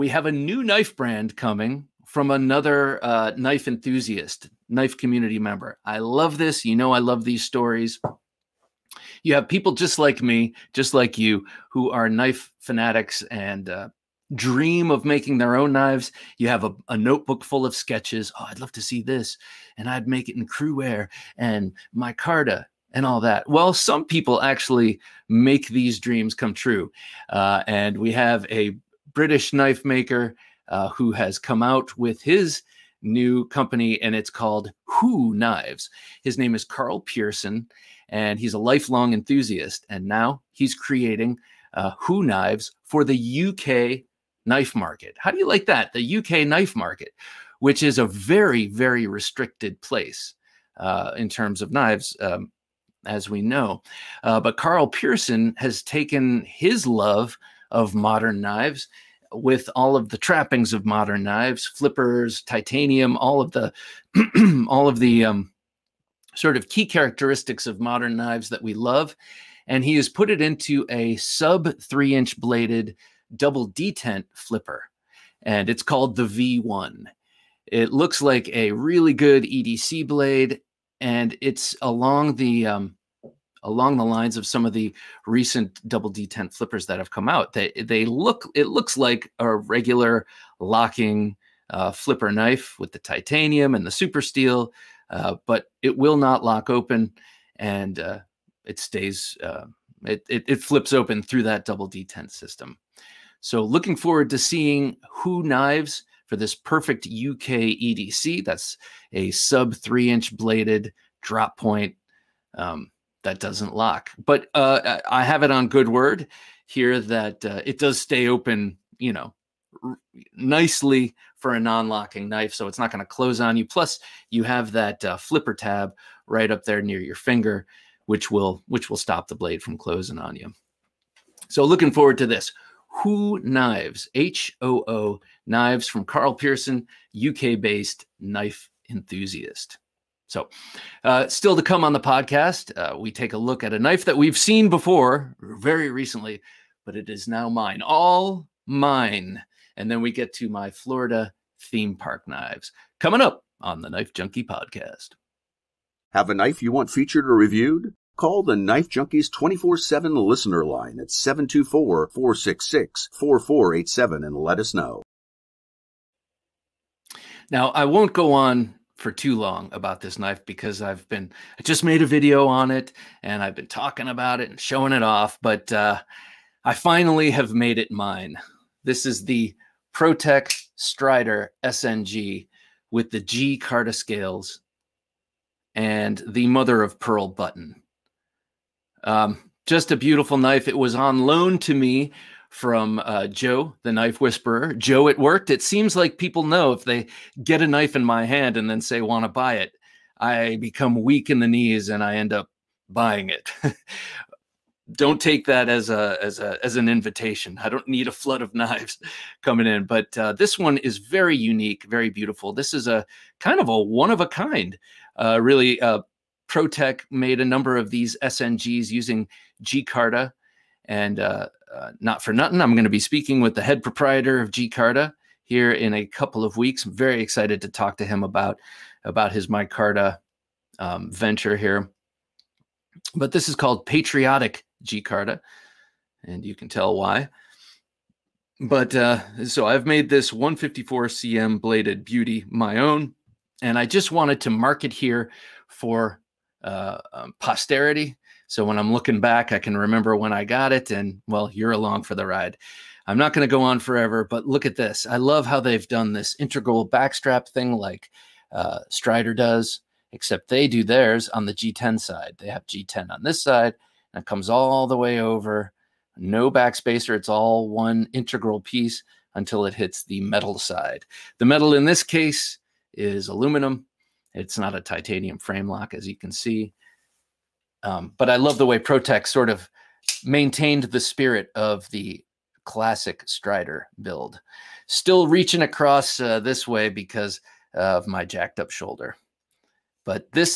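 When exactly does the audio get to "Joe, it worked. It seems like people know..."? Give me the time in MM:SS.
03:14.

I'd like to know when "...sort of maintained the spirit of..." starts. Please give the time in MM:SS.
04:39.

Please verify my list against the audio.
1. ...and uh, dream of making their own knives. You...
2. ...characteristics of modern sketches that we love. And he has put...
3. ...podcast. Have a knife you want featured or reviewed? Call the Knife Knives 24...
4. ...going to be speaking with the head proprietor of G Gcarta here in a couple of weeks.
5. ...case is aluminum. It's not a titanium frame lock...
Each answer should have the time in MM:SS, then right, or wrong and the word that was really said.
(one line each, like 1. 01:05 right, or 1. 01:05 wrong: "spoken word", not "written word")
1. 00:13 right
2. 01:06 wrong: "knives", not "sketches"
3. 02:34 wrong: "Junkies", not "Knives"
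4. 03:42 right
5. 04:32 right.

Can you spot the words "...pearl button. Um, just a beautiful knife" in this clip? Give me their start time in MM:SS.
03:06.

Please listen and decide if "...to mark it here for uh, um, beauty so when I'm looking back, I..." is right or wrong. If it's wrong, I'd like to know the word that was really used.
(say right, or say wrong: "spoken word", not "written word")
wrong: "posterity", not "beauty".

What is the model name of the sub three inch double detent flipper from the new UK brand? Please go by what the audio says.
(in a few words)
V1.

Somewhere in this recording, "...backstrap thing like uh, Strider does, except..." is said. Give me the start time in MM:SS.
04:16.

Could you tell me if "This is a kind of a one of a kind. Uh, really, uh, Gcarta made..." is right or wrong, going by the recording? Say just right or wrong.
wrong.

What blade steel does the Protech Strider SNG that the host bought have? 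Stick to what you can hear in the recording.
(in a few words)
154 cm.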